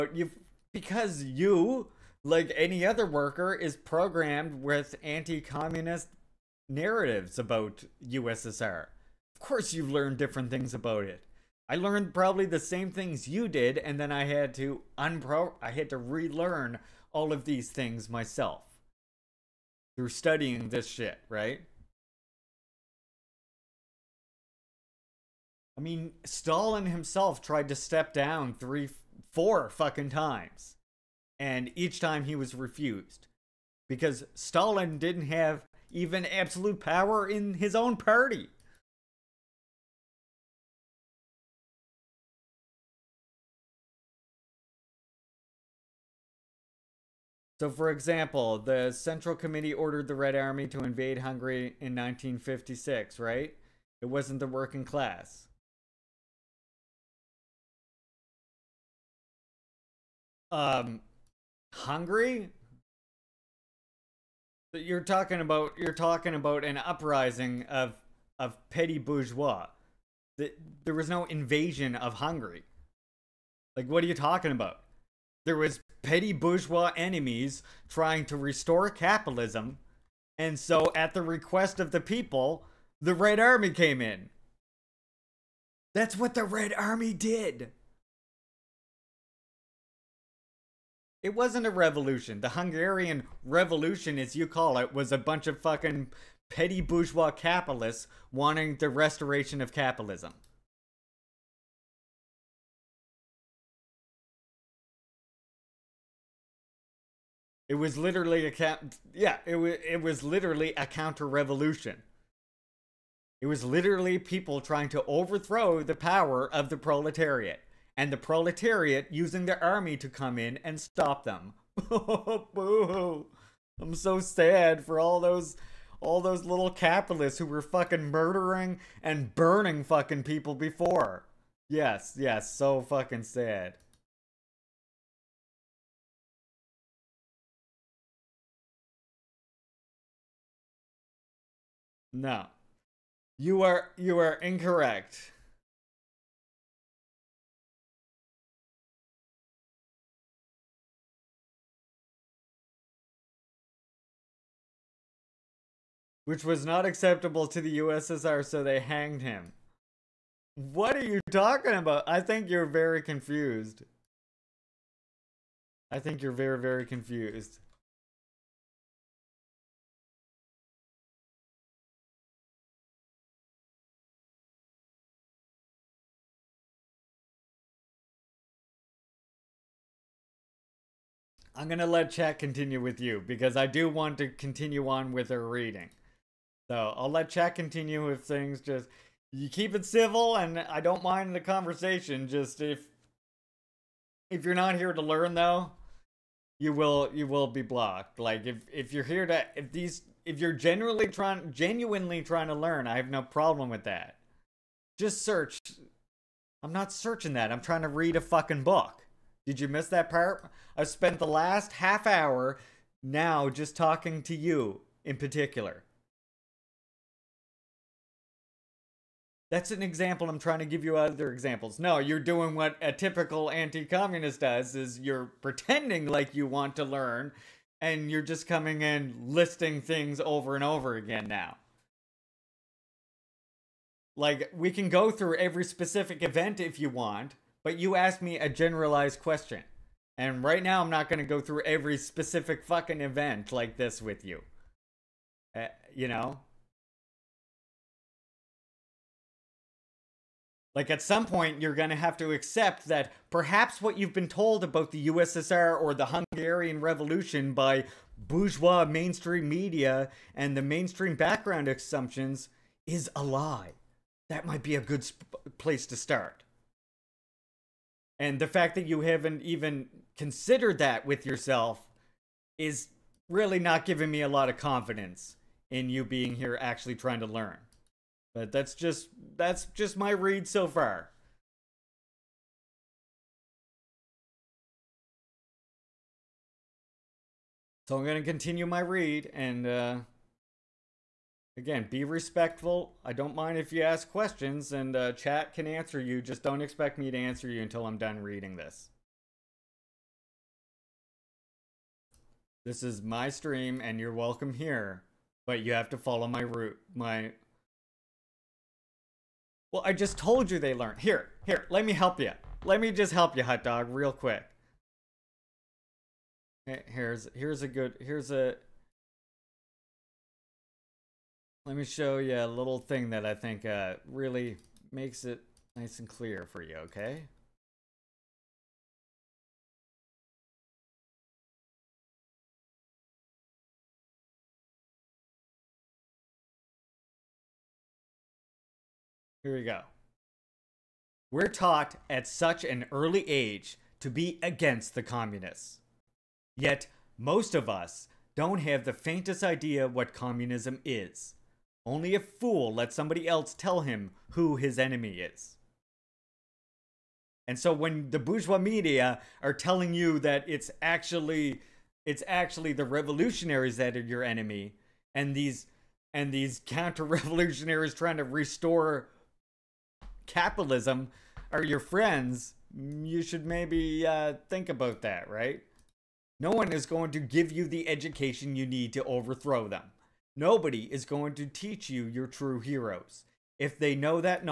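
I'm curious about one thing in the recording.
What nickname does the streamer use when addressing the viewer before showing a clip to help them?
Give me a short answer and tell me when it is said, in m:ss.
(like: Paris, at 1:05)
hot dog, at 5:13.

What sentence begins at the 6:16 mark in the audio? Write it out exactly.
No one is going to give you the education you need to overthrow them.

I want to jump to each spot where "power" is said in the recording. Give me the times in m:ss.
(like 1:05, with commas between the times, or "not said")
0:36, 1:55.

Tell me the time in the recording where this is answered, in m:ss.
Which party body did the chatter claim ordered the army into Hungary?
0:48.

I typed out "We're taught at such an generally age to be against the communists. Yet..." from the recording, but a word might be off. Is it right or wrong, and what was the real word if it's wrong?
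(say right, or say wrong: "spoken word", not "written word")
wrong: "early", not "generally".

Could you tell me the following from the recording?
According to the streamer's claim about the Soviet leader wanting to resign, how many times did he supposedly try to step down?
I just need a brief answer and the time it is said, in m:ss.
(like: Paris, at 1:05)
3 or 4, at 0:28.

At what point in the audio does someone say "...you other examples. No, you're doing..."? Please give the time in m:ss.
3:40.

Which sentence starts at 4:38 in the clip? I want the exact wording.
But that's just that's just my read so far.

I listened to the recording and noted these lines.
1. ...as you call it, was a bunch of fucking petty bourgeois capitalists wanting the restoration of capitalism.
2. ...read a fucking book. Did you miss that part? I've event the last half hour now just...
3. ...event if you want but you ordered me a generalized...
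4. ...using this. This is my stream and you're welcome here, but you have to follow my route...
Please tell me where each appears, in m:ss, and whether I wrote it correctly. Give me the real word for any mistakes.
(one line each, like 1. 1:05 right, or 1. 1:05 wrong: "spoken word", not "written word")
1. 1:34 right
2. 3:27 wrong: "spent", not "event"
3. 3:56 wrong: "asked", not "ordered"
4. 4:58 wrong: "reading", not "using".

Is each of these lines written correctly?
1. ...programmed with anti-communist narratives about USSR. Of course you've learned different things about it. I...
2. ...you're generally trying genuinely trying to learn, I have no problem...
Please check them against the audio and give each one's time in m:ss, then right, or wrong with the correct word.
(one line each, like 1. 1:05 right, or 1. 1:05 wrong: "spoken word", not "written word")
1. 0:03 right
2. 3:20 right.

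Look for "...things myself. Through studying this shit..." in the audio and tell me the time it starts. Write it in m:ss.
0:17.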